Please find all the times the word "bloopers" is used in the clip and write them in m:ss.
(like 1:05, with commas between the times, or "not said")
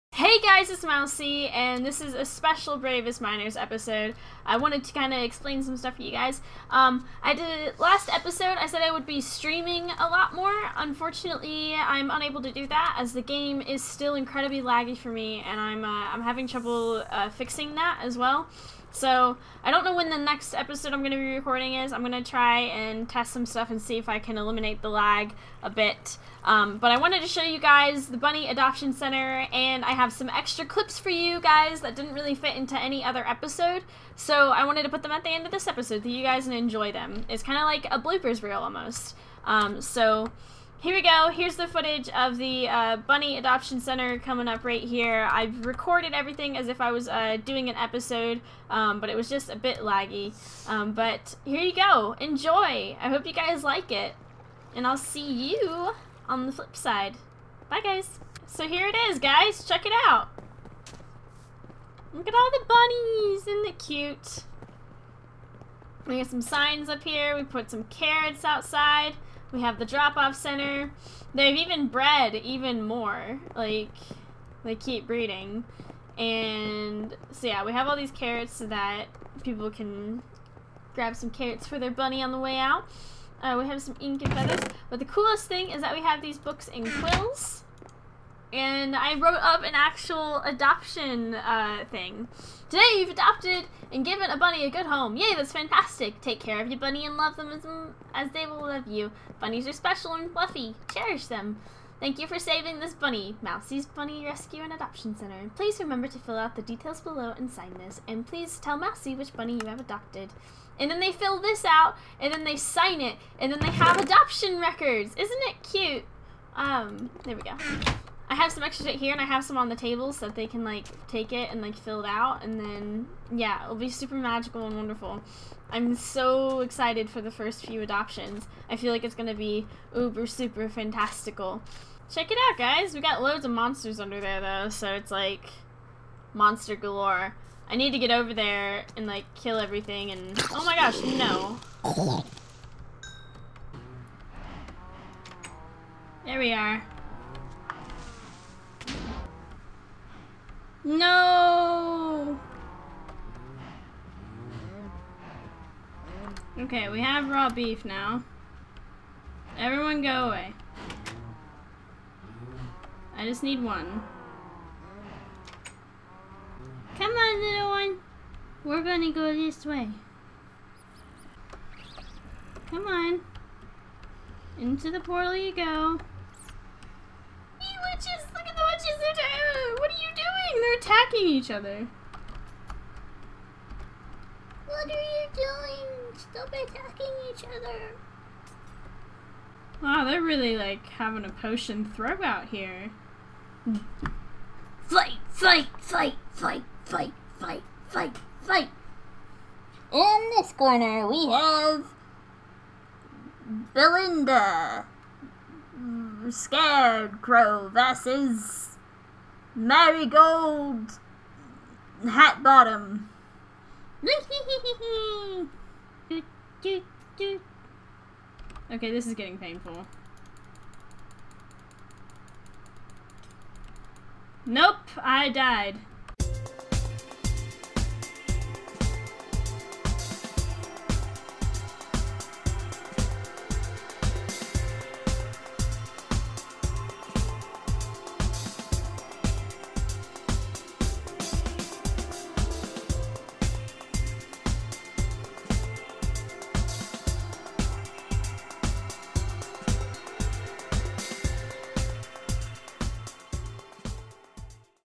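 0:38.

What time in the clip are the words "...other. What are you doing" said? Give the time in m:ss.
3:01.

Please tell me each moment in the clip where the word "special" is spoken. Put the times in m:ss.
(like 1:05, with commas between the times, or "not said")
0:02, 1:39.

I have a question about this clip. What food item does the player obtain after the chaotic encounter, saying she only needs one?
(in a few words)
Raw beef.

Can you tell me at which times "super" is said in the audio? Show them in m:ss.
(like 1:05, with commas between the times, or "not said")
2:03, 2:10.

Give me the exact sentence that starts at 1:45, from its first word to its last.
Please remember to fill out the details below and sign this, and please tell Mousie which bunny you have adopted.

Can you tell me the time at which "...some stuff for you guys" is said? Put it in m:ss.
0:05.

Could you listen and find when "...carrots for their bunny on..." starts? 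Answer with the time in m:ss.
1:21.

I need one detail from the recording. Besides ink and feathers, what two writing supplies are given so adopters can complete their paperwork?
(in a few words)
Books and quills.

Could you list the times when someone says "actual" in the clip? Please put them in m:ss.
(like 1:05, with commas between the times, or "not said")
1:29.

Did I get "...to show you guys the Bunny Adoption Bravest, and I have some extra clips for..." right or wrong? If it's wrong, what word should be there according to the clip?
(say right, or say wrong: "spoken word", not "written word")
wrong: "Center", not "Bravest".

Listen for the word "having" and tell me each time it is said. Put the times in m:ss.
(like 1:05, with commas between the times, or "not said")
0:16, 3:10.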